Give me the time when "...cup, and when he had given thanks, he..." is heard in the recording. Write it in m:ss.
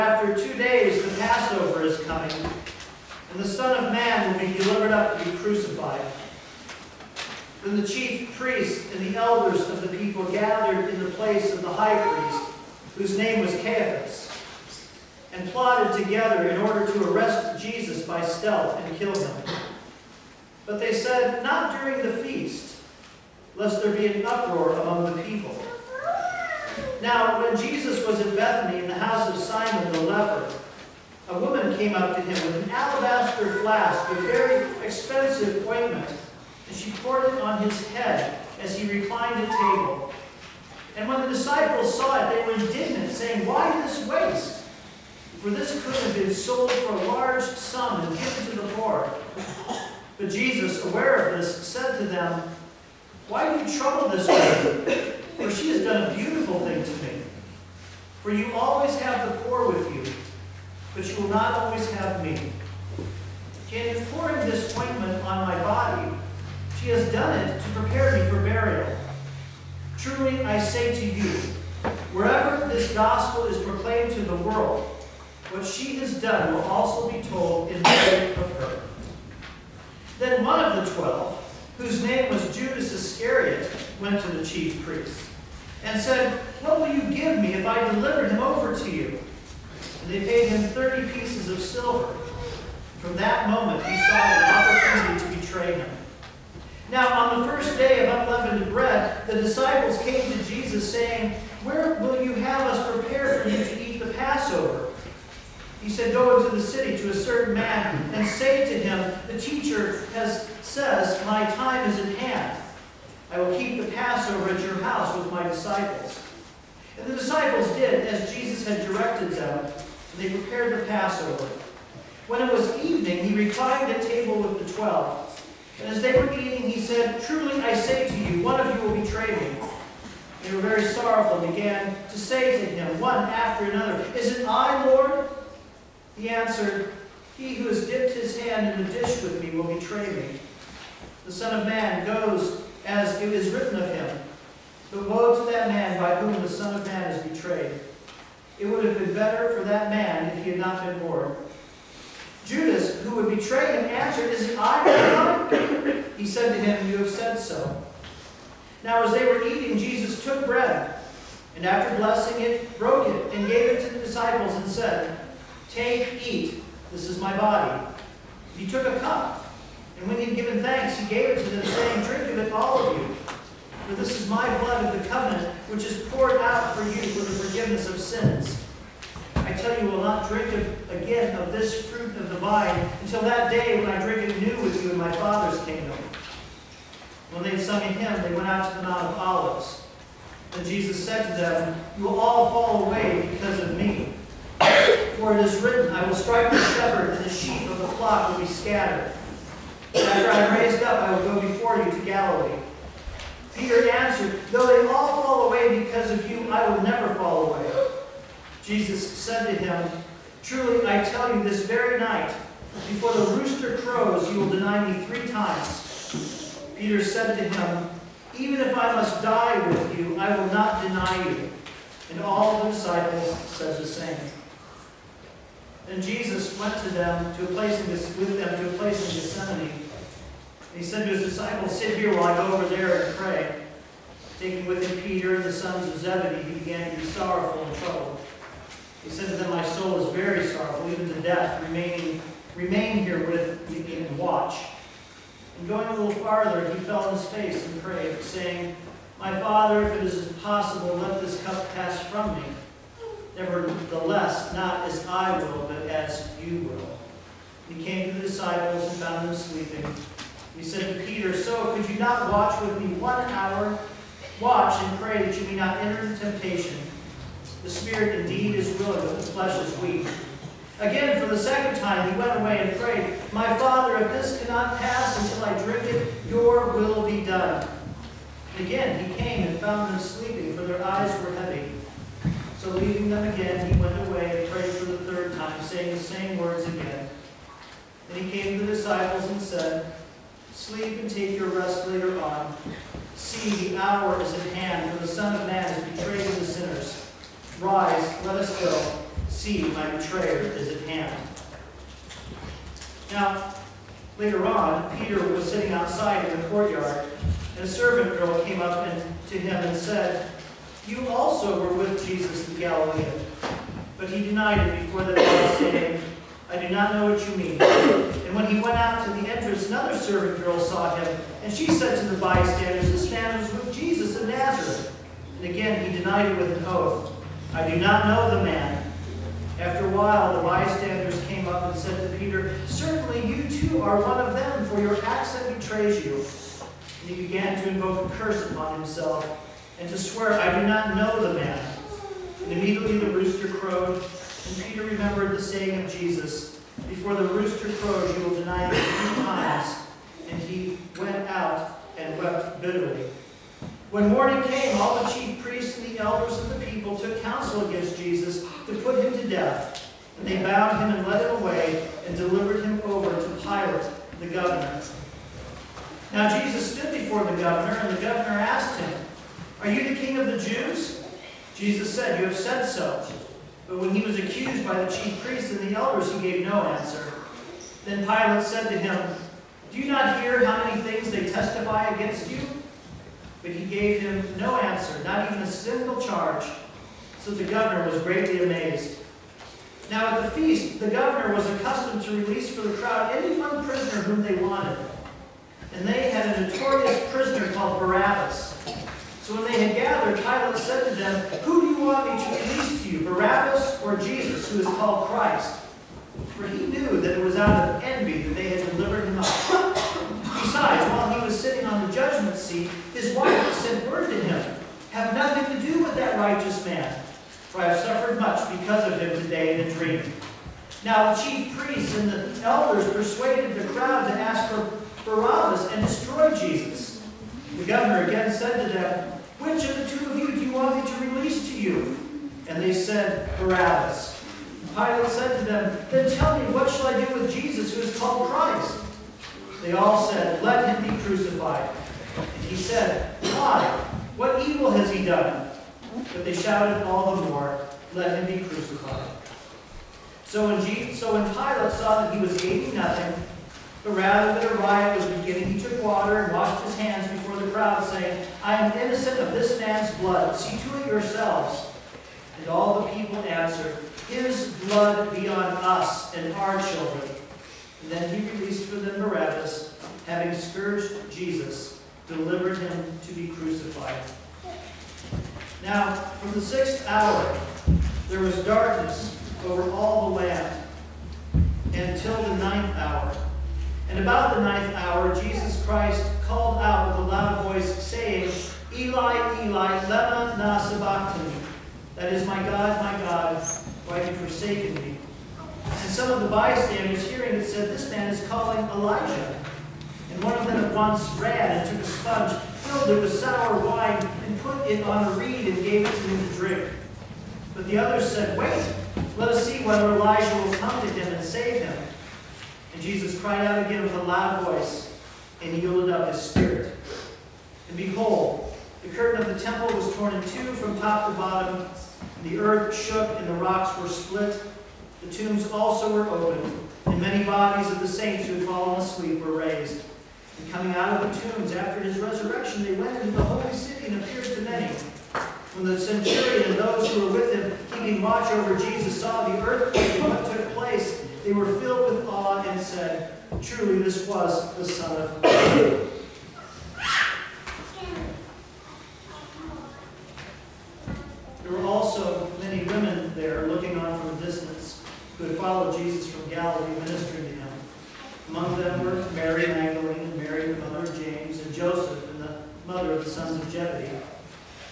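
2:48.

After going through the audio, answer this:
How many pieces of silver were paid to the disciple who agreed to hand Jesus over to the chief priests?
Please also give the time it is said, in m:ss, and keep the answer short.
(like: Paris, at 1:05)
30, at 1:30.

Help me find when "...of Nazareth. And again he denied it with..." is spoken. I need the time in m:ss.
5:24.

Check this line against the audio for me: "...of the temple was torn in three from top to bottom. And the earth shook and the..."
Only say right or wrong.
wrong.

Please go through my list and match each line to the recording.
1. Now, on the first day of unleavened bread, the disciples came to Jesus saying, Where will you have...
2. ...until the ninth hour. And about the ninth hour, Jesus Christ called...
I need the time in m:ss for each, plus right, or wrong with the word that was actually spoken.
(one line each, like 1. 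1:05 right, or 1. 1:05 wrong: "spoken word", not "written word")
1. 1:36 right
2. 8:01 right.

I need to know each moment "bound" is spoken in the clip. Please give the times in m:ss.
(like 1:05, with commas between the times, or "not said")
6:00.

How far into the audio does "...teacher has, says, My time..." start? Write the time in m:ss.
1:49.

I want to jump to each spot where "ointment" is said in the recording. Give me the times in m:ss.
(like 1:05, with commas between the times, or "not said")
0:35, 1:04.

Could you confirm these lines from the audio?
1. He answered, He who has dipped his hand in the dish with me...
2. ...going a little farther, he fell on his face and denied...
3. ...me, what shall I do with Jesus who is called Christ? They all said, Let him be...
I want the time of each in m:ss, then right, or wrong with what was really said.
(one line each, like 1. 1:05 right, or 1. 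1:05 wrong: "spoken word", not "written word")
1. 2:16 right
2. 4:05 wrong: "prayed", not "denied"
3. 7:16 right.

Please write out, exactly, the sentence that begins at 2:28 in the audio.
It would have been better for that man if he had not been born.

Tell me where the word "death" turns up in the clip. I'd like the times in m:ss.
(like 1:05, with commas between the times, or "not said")
4:01, 5:59.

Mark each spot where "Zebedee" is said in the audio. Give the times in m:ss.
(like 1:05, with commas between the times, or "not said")
3:55, 9:23.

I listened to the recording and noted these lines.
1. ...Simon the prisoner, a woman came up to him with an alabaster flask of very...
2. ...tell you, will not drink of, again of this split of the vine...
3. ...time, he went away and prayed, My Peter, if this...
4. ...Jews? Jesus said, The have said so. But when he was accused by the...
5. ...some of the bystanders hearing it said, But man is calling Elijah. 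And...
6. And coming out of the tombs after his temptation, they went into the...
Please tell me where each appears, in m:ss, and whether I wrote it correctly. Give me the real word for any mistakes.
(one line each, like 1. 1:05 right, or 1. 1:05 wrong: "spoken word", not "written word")
1. 0:29 wrong: "leper", not "prisoner"
2. 2:59 wrong: "fruit", not "split"
3. 4:31 wrong: "Father", not "Peter"
4. 6:10 wrong: "You", not "The"
5. 8:15 wrong: "This", not "But"
6. 8:50 wrong: "resurrection", not "temptation".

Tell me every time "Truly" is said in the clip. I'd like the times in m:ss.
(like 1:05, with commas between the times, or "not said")
1:09, 2:07, 3:30, 9:03.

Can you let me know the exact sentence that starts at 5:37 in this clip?
And he began to invoke a curse upon himself and to swear, I do not know the man.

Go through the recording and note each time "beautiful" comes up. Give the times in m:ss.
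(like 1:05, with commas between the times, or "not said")
0:56.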